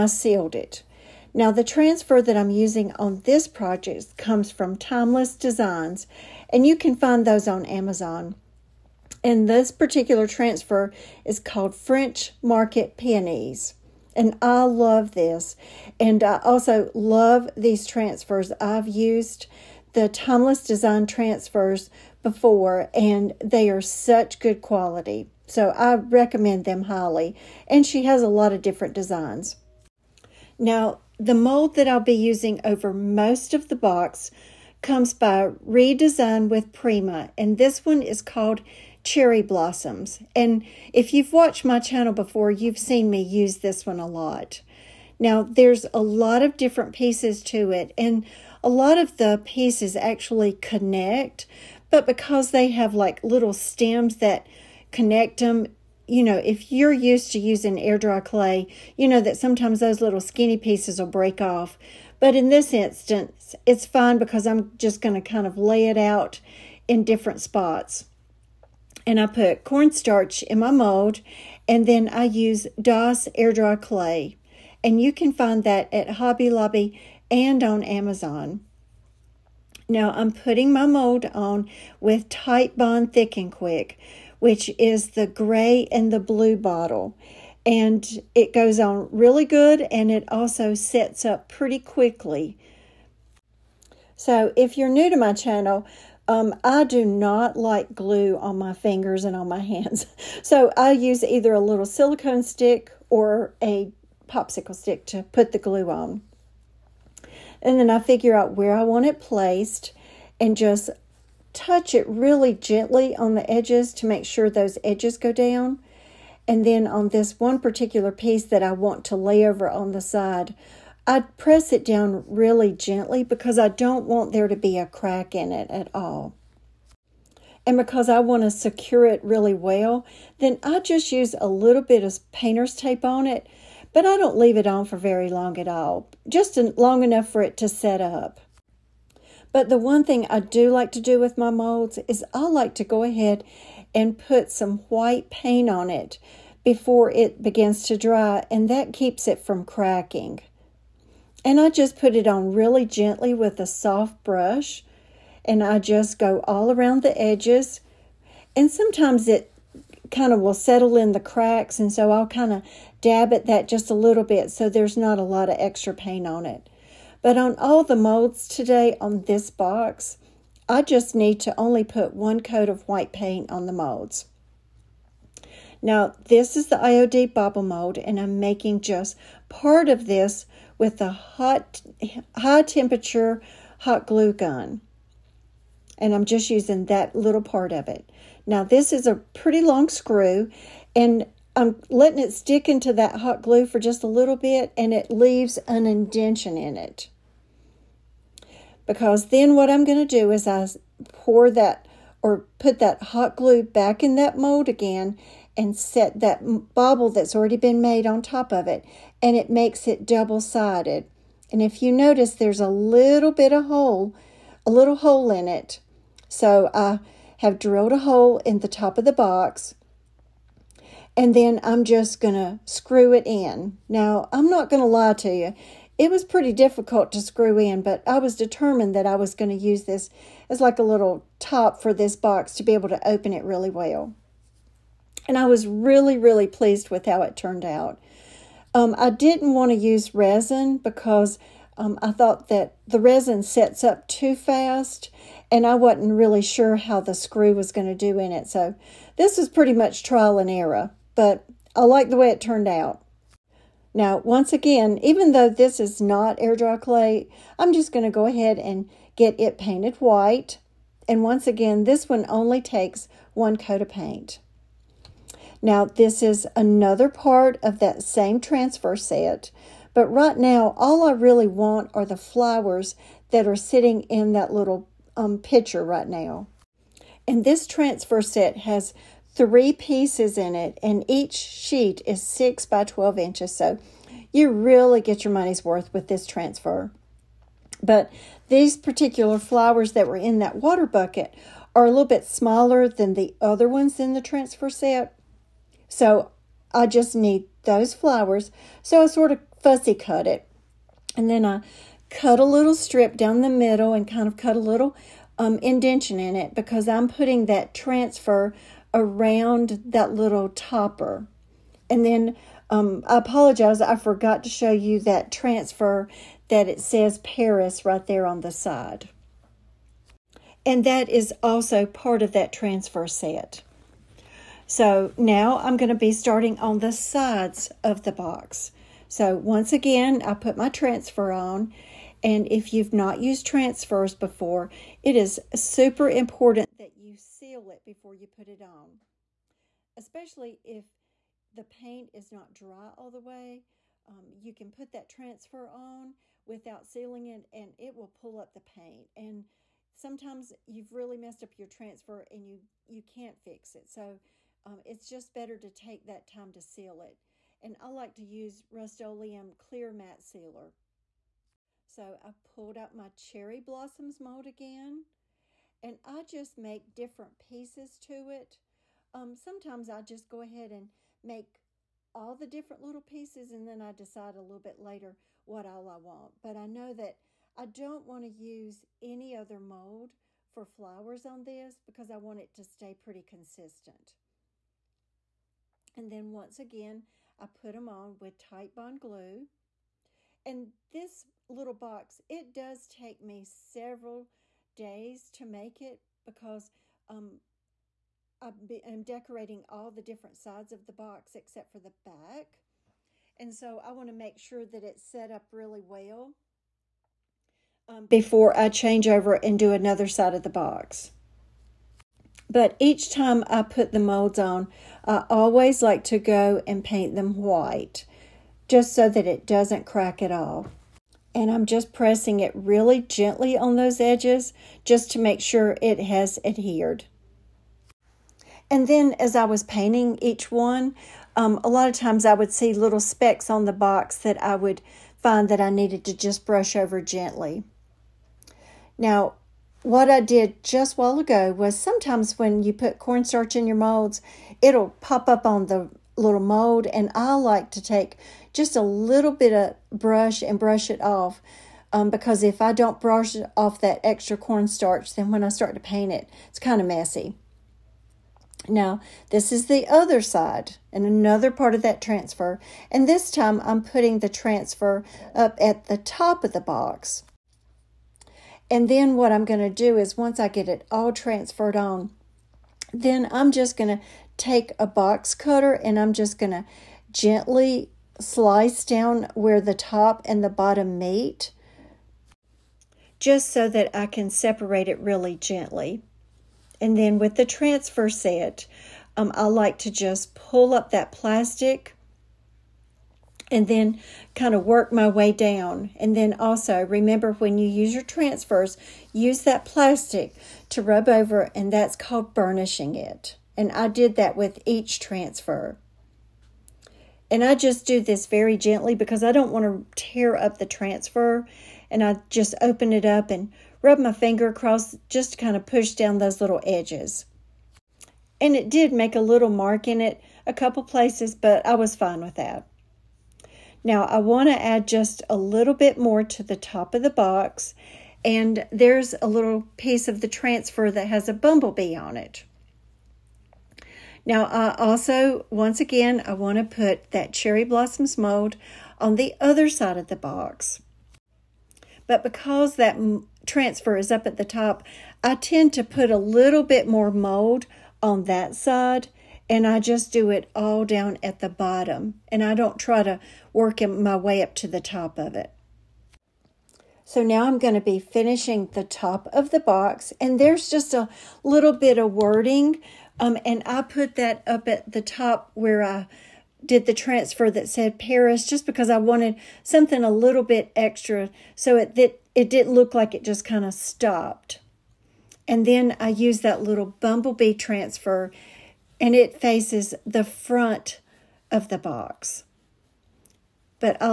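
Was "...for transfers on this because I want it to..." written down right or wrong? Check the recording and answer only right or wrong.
wrong.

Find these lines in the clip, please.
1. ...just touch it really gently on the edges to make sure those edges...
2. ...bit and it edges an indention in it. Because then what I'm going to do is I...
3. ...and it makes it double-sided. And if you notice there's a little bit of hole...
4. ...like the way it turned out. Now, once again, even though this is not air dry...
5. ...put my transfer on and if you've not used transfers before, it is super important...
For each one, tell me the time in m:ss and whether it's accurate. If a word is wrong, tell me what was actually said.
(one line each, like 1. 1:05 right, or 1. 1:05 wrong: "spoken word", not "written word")
1. 1:50 right
2. 3:14 wrong: "leaves", not "edges"
3. 3:29 right
4. 4:11 right
5. 5:30 right.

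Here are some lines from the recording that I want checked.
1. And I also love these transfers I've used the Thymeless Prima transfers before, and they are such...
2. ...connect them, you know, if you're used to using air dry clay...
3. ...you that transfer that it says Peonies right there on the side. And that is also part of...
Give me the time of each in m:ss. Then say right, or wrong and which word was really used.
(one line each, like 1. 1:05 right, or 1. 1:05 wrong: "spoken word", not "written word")
1. 0:15 wrong: "Design", not "Prima"
2. 0:54 right
3. 5:14 wrong: "Paris", not "Peonies".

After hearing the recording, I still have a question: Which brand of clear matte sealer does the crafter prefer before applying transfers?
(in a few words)
Rust-Oleum.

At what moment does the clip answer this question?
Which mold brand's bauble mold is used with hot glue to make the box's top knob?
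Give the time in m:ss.
2:56.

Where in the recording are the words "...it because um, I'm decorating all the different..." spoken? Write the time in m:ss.
6:35.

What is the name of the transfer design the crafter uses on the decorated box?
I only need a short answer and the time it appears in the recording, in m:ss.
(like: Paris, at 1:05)
French Market Peonies, at 0:11.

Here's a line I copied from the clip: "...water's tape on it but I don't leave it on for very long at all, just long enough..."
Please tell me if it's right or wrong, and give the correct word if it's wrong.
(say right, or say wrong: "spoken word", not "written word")
wrong: "painter", not "water".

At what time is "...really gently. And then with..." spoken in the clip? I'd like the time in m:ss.
8:04.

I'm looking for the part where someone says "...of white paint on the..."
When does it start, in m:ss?
2:52.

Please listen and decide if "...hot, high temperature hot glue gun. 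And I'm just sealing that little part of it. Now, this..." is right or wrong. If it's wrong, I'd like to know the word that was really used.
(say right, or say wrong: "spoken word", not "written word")
wrong: "using", not "sealing".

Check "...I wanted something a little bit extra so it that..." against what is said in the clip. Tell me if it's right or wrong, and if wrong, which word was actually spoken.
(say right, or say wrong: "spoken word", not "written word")
right.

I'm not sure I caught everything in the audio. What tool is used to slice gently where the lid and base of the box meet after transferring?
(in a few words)
Box cutter.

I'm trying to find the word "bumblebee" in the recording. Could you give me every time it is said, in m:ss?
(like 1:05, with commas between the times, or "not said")
8:51, 9:36.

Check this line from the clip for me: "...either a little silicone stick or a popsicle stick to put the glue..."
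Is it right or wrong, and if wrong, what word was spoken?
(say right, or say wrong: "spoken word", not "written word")
right.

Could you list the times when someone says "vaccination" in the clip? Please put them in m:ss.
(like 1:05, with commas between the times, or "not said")
not said.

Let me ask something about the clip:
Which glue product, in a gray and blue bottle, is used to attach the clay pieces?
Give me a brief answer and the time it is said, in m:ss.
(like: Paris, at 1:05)
Titebond Thick and Quick, at 1:22.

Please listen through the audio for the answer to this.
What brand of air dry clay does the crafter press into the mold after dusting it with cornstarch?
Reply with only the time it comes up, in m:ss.
1:12.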